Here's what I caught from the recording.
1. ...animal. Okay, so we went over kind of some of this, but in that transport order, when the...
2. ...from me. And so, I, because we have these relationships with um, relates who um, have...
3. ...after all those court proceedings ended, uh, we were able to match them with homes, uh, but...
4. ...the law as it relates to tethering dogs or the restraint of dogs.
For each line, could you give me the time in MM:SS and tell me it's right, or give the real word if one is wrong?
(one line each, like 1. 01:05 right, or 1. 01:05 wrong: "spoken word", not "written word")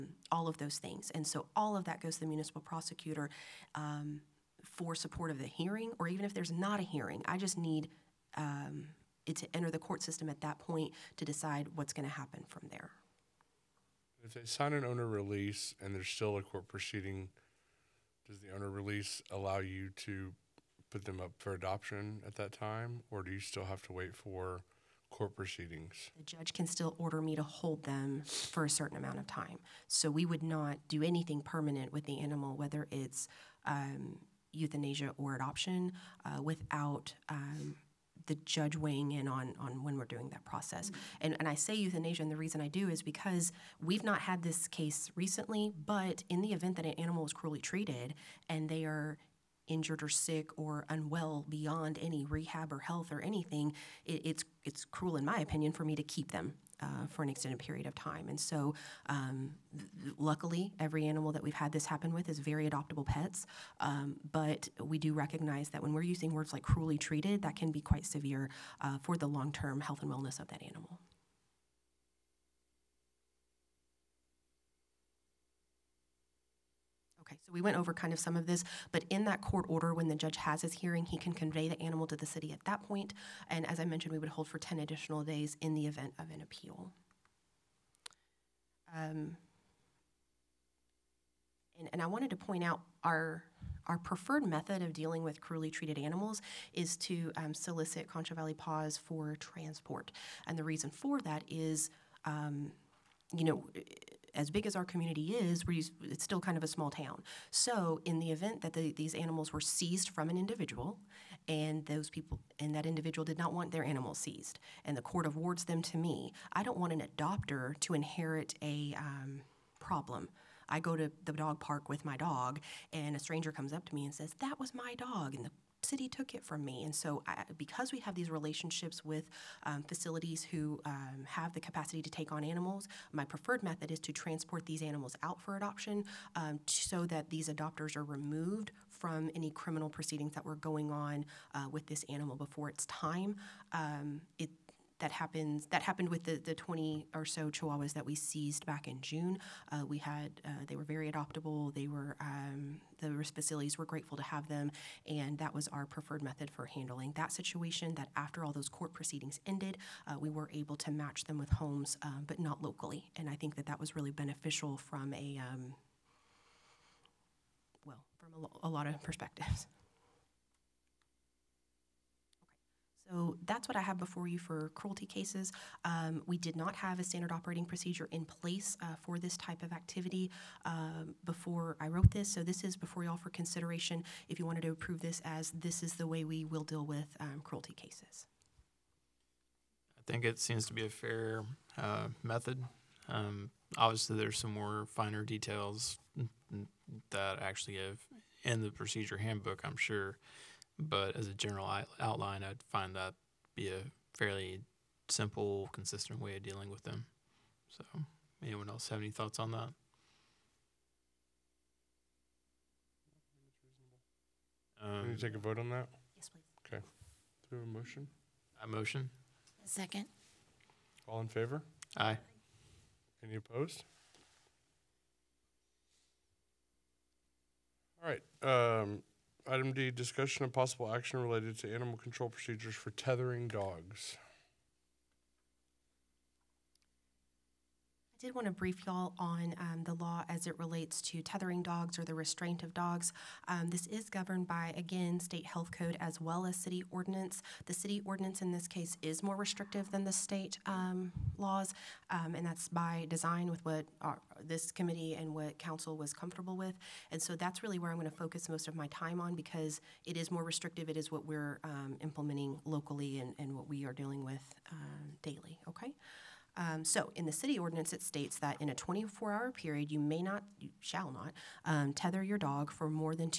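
1. 01:10 wrong: "court", not "transport"
2. 02:06 wrong: "facilities", not "relates"
3. 02:38 right
4. 03:59 right.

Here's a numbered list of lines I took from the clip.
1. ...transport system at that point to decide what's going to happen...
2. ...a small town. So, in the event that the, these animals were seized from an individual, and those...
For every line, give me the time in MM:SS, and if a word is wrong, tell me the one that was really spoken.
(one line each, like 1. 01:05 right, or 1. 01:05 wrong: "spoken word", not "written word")
1. 00:09 wrong: "court", not "transport"
2. 01:46 right.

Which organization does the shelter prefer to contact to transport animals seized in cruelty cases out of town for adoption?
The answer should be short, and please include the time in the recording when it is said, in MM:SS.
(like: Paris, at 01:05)
Concho Valley Paws, at 01:38.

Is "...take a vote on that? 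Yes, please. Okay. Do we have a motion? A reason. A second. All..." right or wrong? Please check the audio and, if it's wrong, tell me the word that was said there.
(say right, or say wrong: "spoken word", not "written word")
wrong: "motion", not "reason".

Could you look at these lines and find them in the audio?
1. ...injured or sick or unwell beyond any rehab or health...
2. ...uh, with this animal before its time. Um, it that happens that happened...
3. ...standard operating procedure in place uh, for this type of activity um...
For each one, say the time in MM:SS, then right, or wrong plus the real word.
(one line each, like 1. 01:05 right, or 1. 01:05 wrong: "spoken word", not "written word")
1. 00:49 right
2. 02:21 right
3. 02:57 right.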